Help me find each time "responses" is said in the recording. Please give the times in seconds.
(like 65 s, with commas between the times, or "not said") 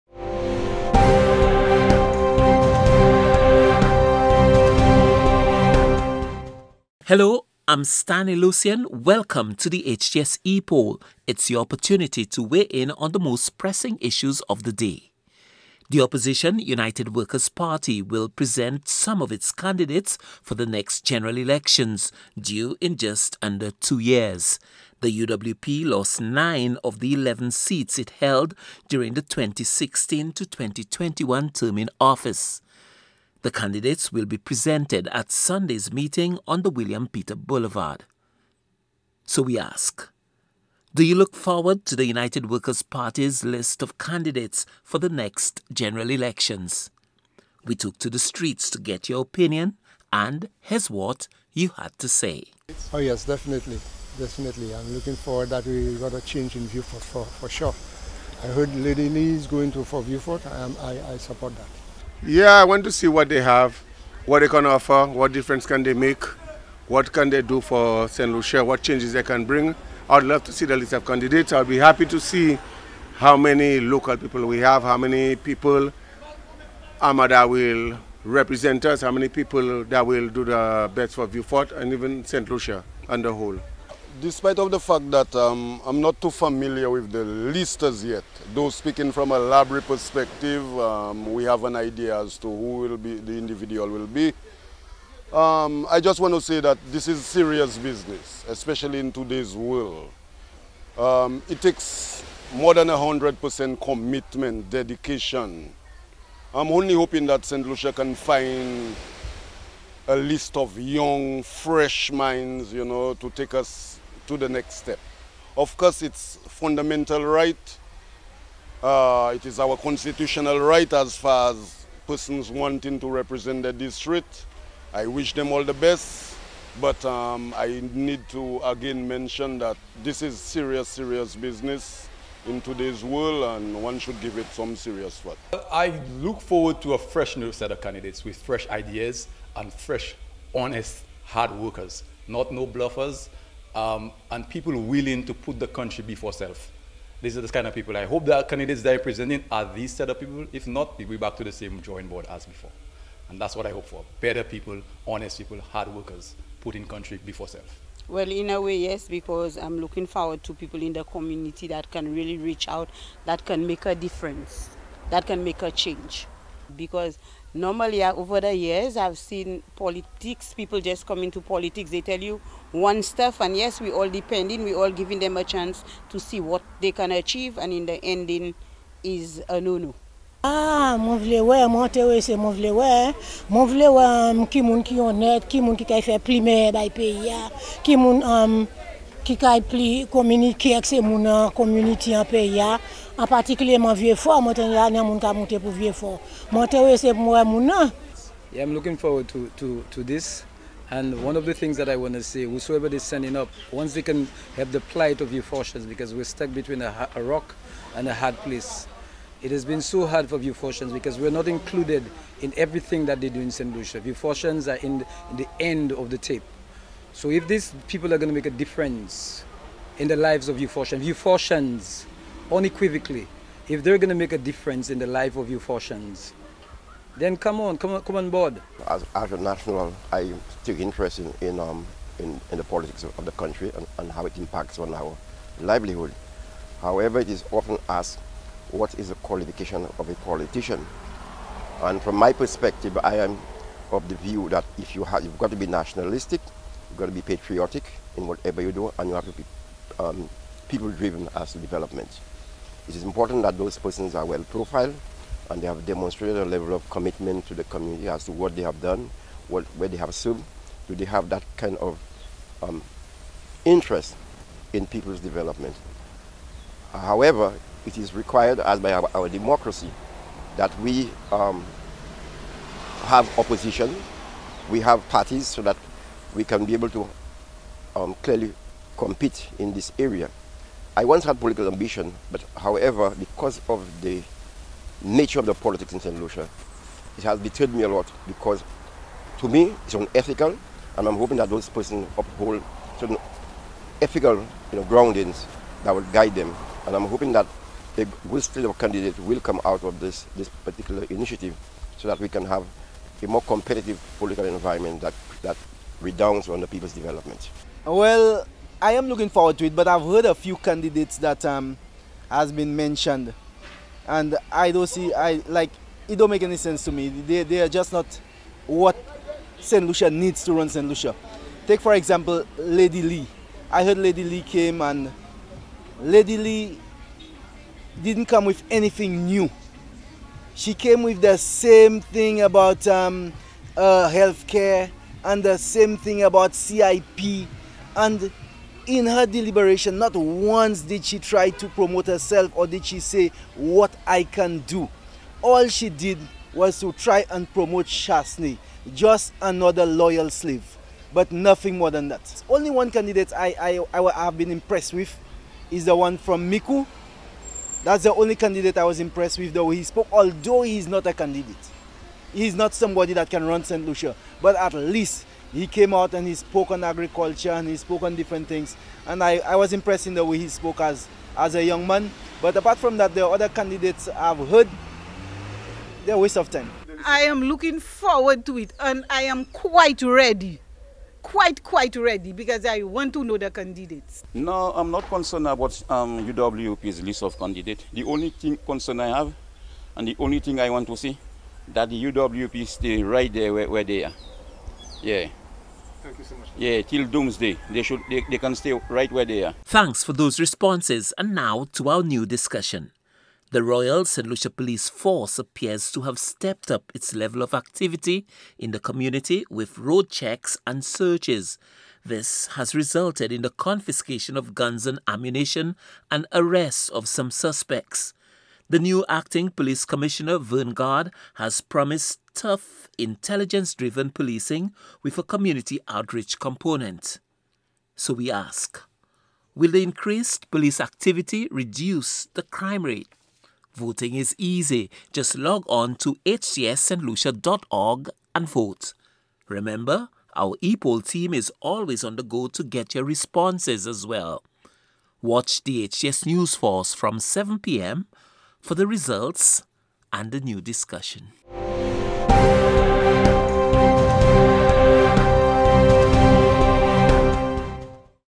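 400 s, 443 s.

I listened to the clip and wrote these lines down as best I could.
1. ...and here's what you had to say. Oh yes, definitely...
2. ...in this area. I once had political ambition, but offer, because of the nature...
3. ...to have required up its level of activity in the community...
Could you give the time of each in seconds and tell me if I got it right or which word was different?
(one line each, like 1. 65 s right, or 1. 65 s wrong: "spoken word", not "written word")
1. 50 s right
2. 279 s wrong: "however", not "offer"
3. 405 s wrong: "stepped", not "required".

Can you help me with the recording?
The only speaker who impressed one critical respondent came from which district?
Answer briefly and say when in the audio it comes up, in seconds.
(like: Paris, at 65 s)
Micoud, at 356 s.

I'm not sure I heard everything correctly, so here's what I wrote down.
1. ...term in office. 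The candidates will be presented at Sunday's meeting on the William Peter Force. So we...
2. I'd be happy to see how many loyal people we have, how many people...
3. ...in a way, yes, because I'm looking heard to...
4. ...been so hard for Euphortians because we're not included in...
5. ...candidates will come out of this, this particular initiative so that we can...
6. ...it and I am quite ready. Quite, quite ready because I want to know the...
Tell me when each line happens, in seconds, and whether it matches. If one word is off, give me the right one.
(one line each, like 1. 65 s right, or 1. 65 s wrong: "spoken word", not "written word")
1. 31 s wrong: "Boulevard", not "Force"
2. 71 s wrong: "local", not "loyal"
3. 158 s wrong: "forward", not "heard"
4. 209 s right
5. 298 s right
6. 378 s right.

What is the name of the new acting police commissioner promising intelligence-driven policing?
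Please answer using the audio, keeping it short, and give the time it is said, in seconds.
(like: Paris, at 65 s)
Verne Garde, at 420 s.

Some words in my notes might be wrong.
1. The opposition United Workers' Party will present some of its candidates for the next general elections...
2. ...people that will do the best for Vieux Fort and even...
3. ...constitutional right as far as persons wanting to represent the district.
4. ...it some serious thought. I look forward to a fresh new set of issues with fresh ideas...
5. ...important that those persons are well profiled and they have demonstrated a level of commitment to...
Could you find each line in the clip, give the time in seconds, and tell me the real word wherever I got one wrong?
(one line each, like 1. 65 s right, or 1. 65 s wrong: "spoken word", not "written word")
1. 15 s right
2. 79 s right
3. 119 s right
4. 134 s wrong: "candidates", not "issues"
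5. 253 s right.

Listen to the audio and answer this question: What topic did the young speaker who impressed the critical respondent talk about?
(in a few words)
agriculture.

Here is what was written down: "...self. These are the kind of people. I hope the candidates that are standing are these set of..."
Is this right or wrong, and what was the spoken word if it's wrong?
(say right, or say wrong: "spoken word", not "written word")
wrong: "presenting", not "standing".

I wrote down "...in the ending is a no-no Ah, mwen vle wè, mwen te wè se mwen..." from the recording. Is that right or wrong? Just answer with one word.
right.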